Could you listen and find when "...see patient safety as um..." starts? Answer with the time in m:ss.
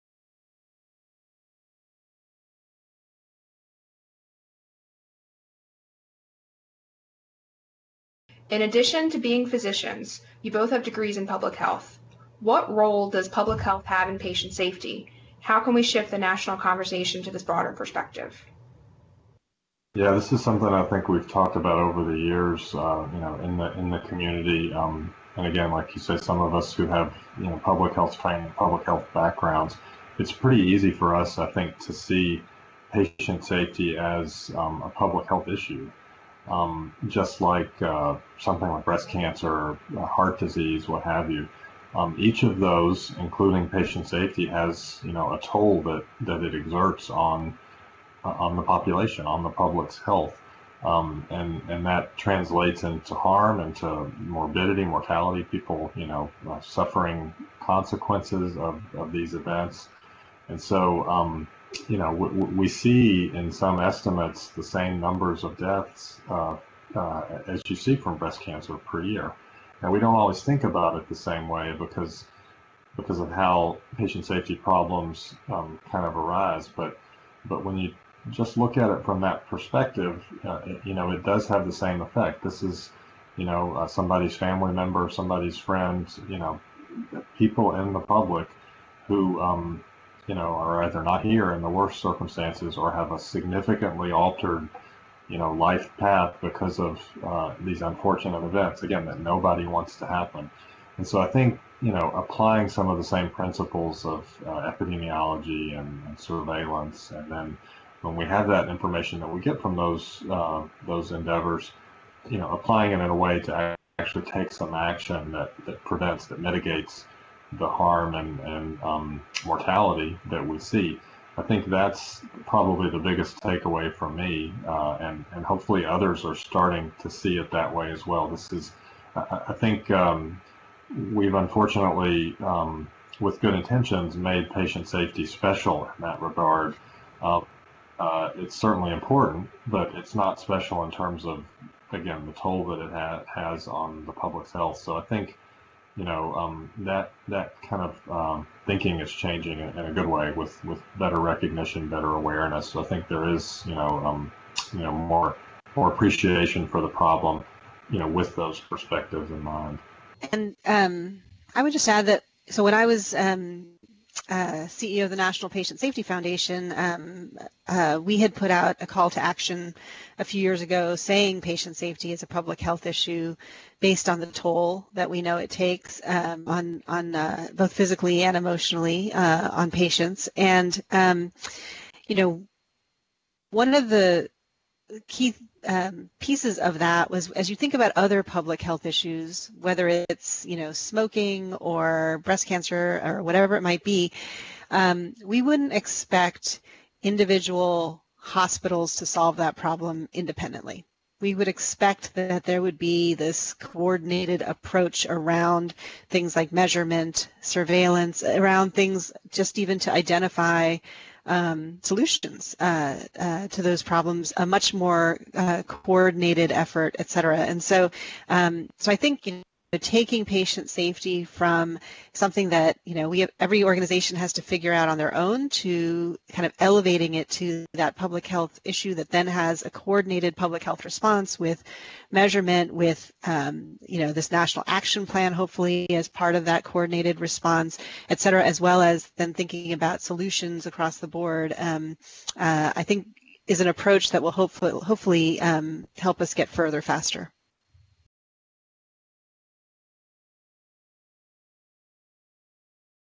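0:31.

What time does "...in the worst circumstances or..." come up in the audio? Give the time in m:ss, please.
1:31.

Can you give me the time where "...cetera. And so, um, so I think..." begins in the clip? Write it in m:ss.
3:37.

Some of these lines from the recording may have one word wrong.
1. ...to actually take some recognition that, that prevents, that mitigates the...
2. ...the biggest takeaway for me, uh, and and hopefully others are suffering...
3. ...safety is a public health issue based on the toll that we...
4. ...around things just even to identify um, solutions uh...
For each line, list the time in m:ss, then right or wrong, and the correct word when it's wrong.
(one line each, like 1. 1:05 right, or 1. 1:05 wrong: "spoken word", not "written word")
1. 1:53 wrong: "action", not "recognition"
2. 2:02 wrong: "starting", not "suffering"
3. 2:51 right
4. 3:28 right.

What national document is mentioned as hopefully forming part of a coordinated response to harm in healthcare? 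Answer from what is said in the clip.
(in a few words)
national action plan.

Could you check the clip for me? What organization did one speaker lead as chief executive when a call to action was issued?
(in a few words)
National Patient Safety Foundation.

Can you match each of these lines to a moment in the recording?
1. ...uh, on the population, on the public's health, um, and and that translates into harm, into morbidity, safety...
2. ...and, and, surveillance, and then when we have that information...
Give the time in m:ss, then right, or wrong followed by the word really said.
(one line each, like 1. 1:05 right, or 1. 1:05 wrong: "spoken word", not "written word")
1. 0:48 wrong: "mortality", not "safety"
2. 1:45 right.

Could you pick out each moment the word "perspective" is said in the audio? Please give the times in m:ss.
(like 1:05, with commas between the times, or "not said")
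0:17, 1:19, 2:38.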